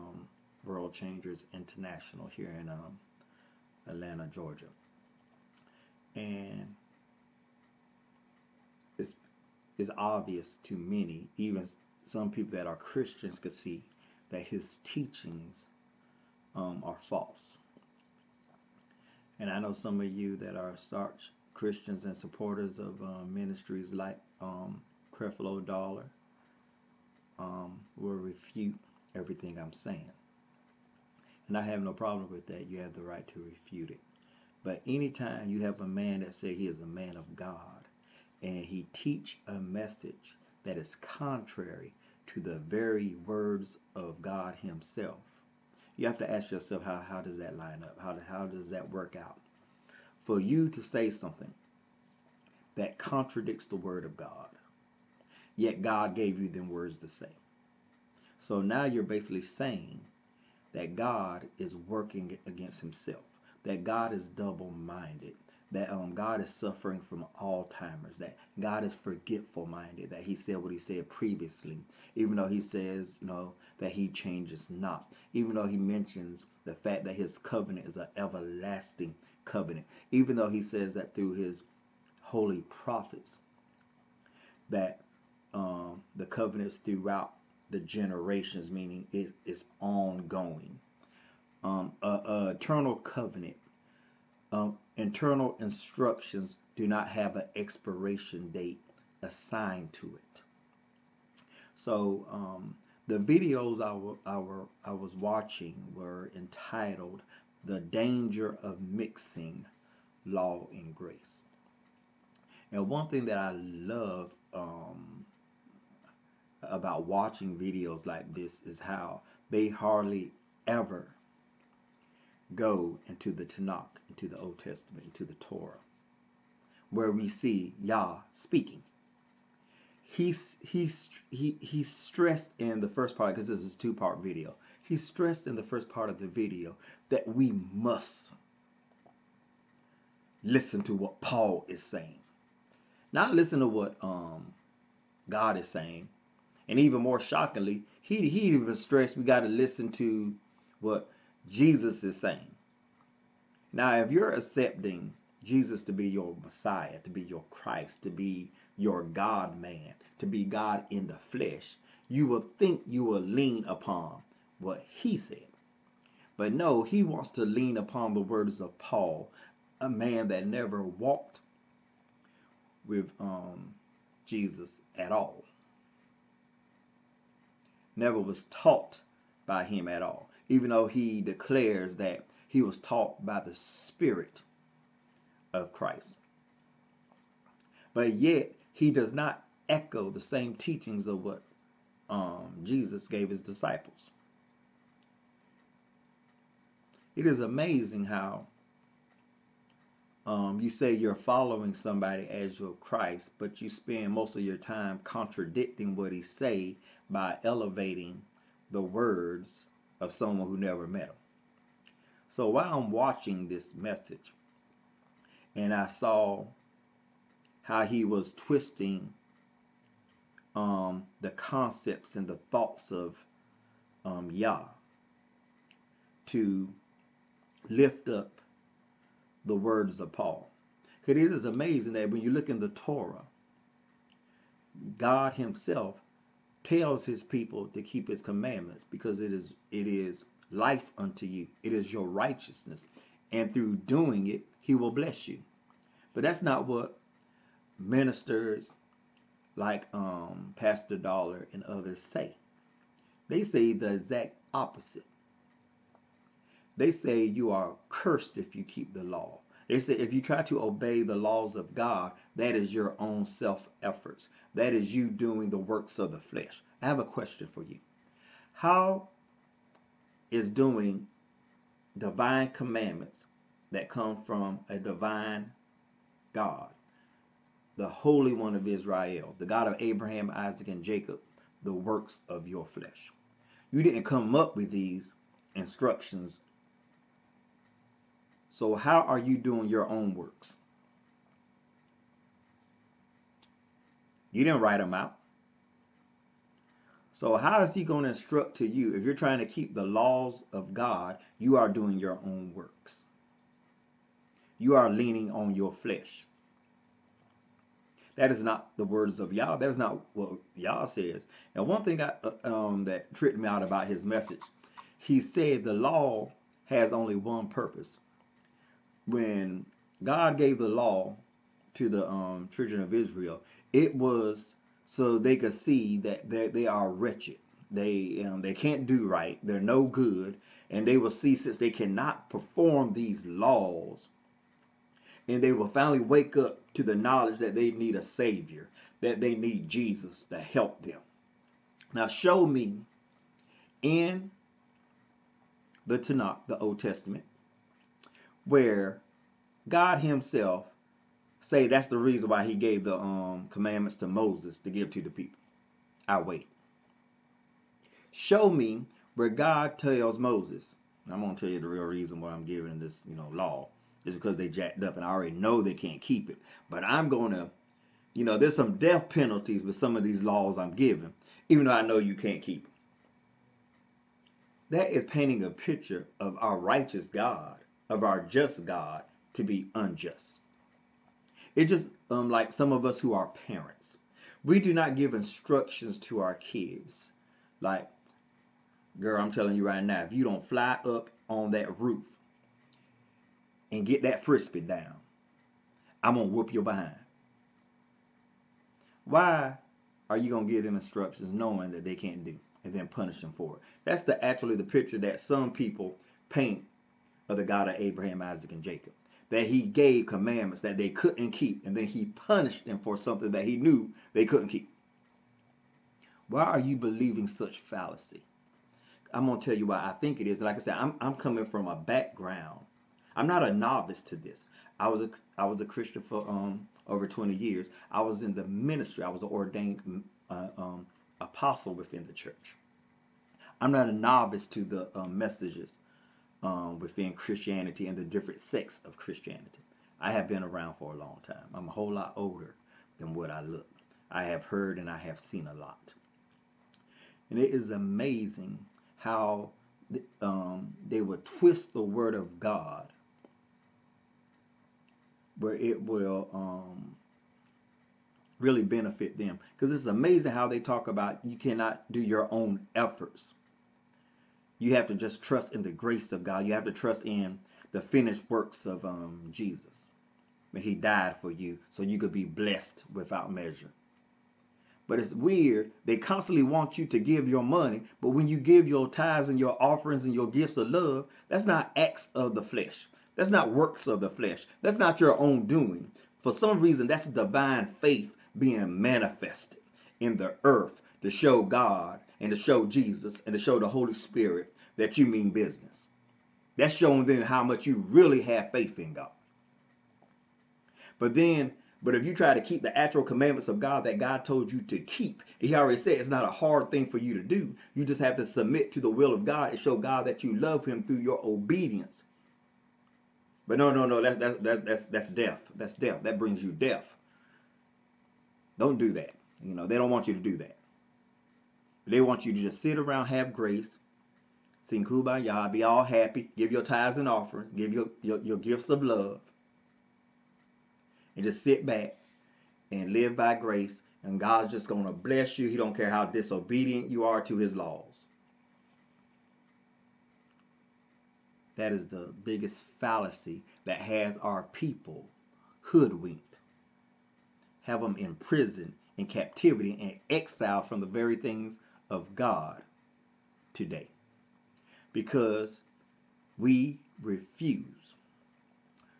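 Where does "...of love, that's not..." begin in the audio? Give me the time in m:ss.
8:00.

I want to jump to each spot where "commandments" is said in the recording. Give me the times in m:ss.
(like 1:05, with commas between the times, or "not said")
3:58, 4:32, 5:53, 6:50, 8:23.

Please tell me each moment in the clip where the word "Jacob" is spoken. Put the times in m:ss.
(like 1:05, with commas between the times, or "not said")
4:40, 6:48.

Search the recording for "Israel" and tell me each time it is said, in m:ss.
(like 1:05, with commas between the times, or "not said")
4:38, 5:22.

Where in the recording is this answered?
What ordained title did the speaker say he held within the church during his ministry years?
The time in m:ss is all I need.
7:11.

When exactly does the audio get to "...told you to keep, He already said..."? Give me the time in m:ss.
8:24.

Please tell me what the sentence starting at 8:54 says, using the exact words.
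And God's just going to bless you.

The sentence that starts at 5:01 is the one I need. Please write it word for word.
You are doing your own works, you are leaning on your flesh.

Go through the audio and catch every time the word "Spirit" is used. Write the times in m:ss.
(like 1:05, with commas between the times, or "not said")
3:03, 8:13.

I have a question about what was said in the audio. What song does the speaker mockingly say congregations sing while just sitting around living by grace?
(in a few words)
Kumbaya.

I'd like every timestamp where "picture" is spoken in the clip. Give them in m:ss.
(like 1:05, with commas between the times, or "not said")
6:15, 6:44.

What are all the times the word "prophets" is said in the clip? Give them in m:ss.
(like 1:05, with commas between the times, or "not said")
1:22.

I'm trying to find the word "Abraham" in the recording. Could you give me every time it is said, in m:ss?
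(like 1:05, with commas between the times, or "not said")
4:39, 6:47.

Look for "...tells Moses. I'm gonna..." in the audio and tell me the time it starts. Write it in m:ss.
5:59.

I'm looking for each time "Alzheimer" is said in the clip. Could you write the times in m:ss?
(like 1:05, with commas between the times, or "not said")
1:07.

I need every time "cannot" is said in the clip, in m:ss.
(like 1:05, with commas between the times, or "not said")
5:31, 7:41.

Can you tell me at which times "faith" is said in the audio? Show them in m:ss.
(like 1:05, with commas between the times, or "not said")
8:07, 8:18.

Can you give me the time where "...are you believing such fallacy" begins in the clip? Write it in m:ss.
6:56.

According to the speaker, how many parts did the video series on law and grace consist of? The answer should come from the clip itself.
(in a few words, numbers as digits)
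2.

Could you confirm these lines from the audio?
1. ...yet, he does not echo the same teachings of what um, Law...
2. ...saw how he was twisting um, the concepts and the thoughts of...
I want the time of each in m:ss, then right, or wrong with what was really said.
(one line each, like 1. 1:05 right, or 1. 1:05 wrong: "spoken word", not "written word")
1. 3:08 wrong: "Jesus", not "Law"
2. 3:35 right.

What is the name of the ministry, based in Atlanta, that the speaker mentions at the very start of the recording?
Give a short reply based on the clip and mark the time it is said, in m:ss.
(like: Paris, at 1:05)
World Changers International, at 0:00.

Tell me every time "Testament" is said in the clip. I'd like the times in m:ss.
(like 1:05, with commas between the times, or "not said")
2:04, 5:46.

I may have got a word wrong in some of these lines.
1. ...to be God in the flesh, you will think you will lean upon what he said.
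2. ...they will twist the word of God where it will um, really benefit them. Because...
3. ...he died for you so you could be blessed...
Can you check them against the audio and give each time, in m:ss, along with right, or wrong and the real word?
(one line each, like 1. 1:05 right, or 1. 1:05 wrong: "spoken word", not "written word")
1. 2:40 right
2. 7:30 right
3. 7:50 right.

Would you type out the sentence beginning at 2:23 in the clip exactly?
Not listen to what um, God is saying.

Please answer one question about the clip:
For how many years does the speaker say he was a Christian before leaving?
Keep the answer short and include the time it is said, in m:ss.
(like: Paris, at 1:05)
Over 20 years, at 7:06.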